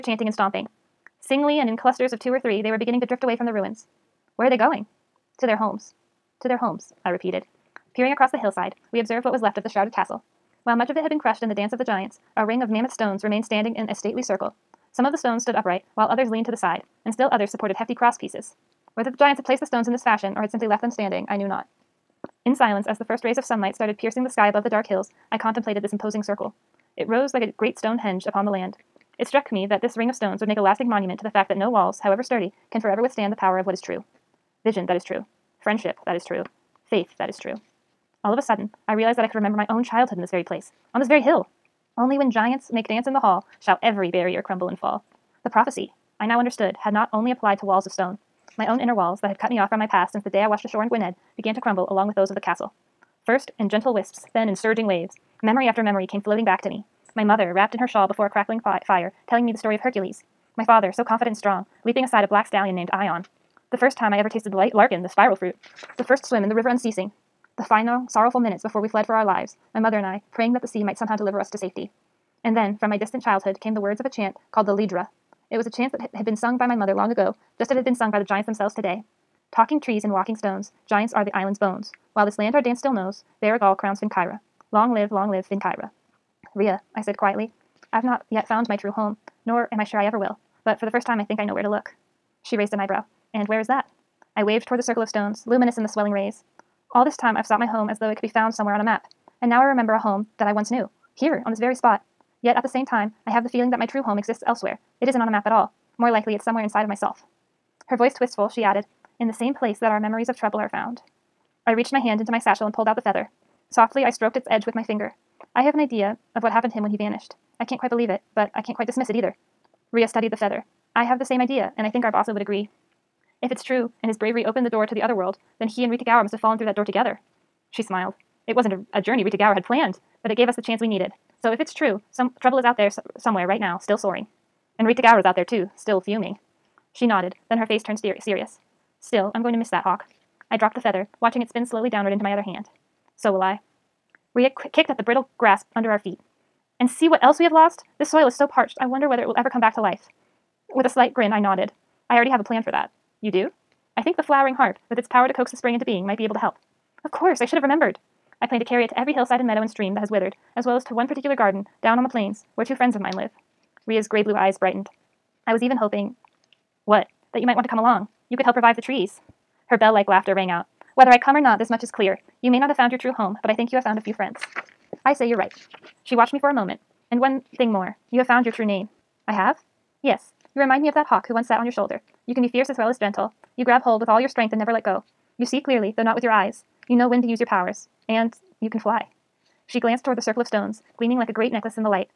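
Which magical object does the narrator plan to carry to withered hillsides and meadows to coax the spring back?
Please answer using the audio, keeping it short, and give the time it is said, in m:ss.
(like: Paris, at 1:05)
the flowering harp, at 2:34.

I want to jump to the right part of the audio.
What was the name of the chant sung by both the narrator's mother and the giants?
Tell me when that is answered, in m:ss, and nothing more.
1:14.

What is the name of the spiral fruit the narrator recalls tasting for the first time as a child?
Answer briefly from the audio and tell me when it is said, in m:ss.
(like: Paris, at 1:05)
larkin, at 1:04.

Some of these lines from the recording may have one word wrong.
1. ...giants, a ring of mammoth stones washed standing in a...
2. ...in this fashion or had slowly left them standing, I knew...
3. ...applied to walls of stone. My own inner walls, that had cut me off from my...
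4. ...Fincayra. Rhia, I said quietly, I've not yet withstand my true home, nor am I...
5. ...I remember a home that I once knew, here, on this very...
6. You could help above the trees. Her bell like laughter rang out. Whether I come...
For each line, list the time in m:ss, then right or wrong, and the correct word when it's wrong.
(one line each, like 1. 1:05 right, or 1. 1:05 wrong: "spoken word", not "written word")
1. 0:11 wrong: "remained", not "washed"
2. 0:19 wrong: "simply", not "slowly"
3. 0:47 right
4. 1:25 wrong: "found", not "withstand"
5. 1:39 right
6. 2:48 wrong: "revive", not "above".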